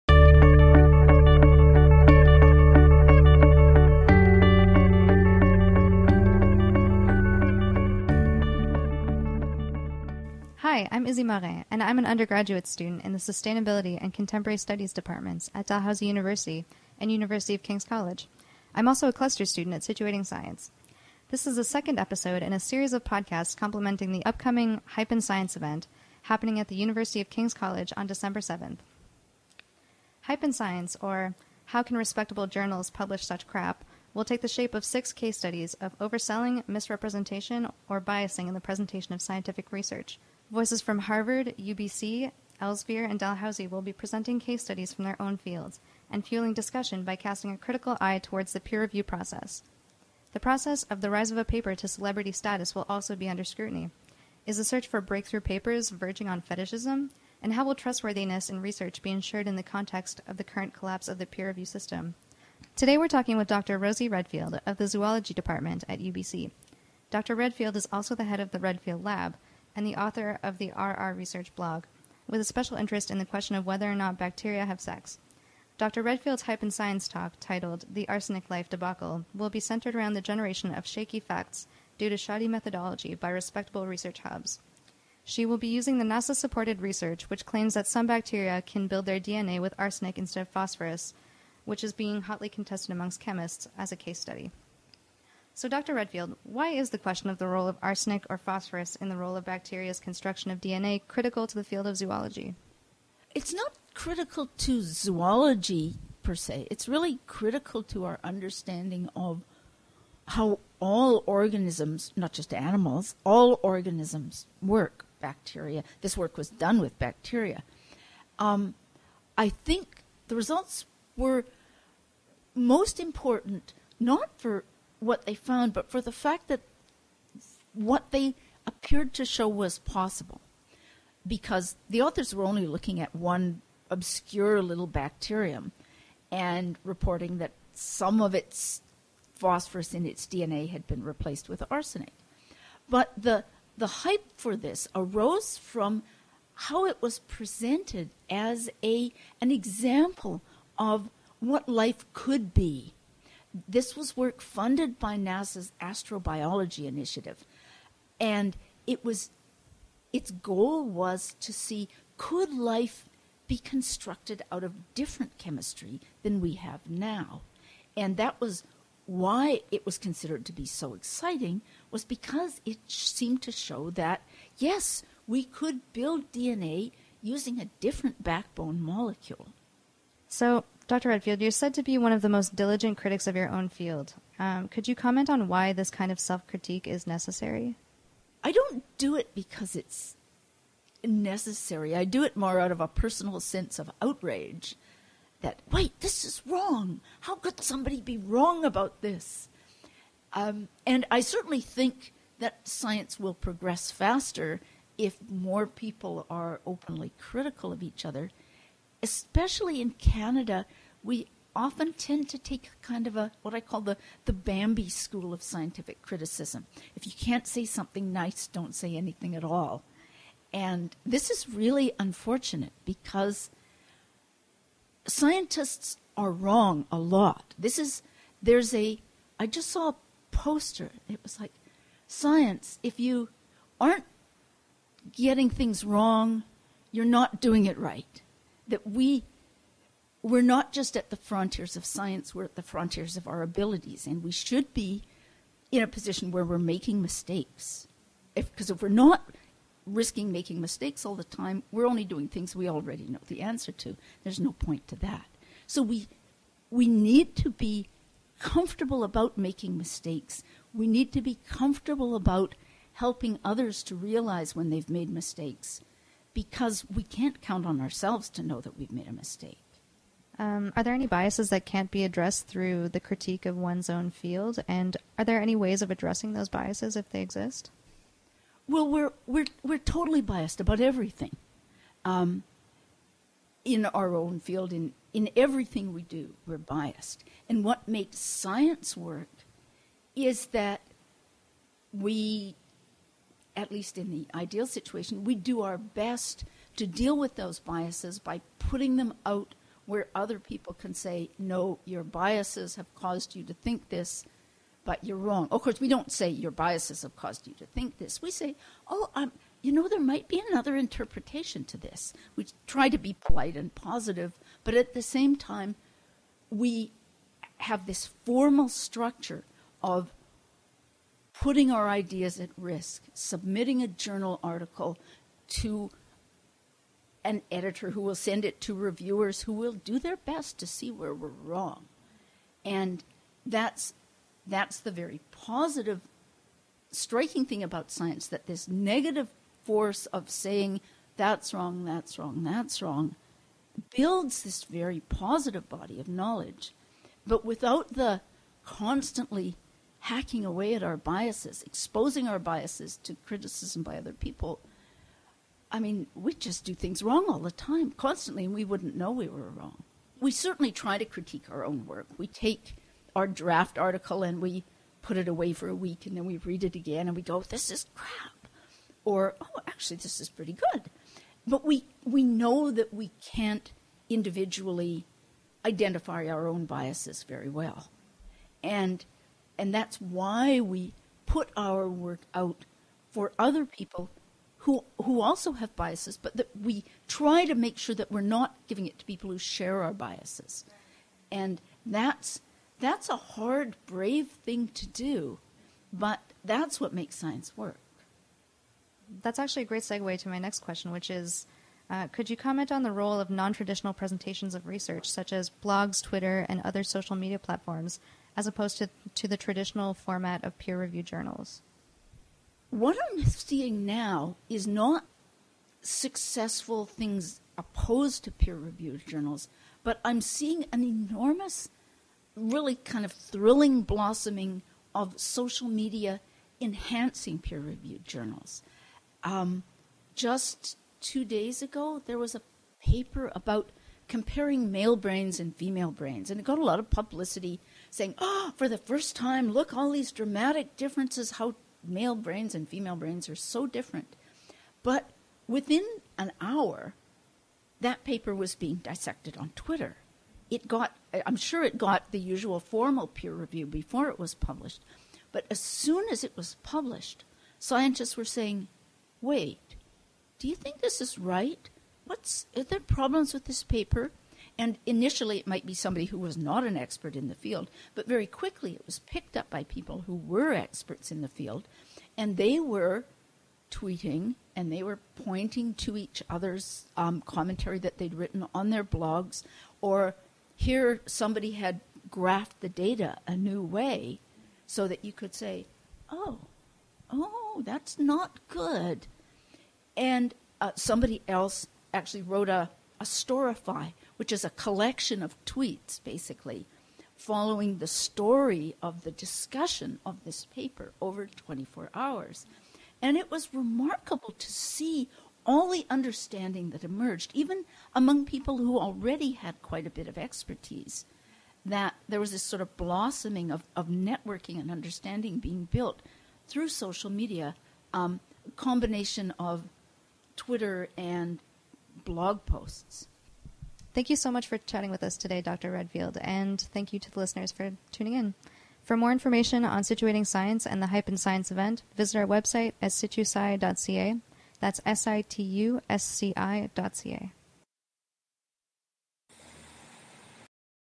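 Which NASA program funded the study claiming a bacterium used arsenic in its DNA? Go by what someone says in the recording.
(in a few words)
astrobiology initiative.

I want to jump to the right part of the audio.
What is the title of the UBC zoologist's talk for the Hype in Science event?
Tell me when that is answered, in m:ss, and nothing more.
1:17.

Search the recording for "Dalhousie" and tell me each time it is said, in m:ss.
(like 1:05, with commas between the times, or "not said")
0:15, 0:43.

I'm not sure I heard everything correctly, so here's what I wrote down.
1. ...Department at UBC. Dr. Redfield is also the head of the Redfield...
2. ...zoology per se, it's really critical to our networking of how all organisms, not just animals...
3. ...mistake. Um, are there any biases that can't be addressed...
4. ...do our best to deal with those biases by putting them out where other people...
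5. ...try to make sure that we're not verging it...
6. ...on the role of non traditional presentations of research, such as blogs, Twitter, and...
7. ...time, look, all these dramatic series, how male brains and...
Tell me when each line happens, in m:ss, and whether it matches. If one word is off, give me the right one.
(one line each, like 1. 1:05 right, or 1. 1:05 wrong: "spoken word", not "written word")
1. 1:05 right
2. 1:44 wrong: "understanding", not "networking"
3. 4:29 right
4. 4:55 right
5. 6:27 wrong: "giving", not "verging"
6. 6:42 right
7. 7:19 wrong: "differences", not "series".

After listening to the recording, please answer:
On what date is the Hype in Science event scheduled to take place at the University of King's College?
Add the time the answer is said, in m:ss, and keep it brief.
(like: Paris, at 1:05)
December 7th, at 0:28.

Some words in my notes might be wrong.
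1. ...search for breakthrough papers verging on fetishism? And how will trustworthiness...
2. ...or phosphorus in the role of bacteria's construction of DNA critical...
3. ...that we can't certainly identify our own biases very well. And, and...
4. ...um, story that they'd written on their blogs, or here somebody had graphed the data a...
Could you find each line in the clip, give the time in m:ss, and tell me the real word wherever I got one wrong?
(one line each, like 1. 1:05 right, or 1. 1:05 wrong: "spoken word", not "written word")
1. 0:54 right
2. 1:38 right
3. 6:12 wrong: "individually", not "certainly"
4. 7:56 wrong: "commentary", not "story".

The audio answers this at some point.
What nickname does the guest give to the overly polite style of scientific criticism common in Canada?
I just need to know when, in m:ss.
3:34.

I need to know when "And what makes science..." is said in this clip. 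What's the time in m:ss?
4:47.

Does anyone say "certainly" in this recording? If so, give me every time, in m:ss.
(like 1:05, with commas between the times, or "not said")
3:21, 6:00.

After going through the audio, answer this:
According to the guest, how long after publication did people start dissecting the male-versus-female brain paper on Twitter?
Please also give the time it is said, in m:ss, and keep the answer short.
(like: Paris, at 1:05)
an hour, at 7:26.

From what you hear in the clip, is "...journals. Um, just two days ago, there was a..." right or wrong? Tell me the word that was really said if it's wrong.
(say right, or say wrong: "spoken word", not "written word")
right.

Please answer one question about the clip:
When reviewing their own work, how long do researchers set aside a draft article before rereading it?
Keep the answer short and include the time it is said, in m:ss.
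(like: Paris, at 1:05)
a week, at 6:05.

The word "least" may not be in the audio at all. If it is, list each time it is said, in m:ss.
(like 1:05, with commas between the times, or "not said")
4:53.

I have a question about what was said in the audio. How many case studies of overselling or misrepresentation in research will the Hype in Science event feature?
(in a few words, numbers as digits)
6.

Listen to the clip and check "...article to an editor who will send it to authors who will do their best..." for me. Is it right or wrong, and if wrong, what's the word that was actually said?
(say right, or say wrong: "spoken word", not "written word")
wrong: "reviewers", not "authors".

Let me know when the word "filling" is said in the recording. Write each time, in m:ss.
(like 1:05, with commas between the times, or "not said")
not said.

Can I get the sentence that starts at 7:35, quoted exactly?
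But as soon as it was published, scientists were saying, wait, do you think this is right?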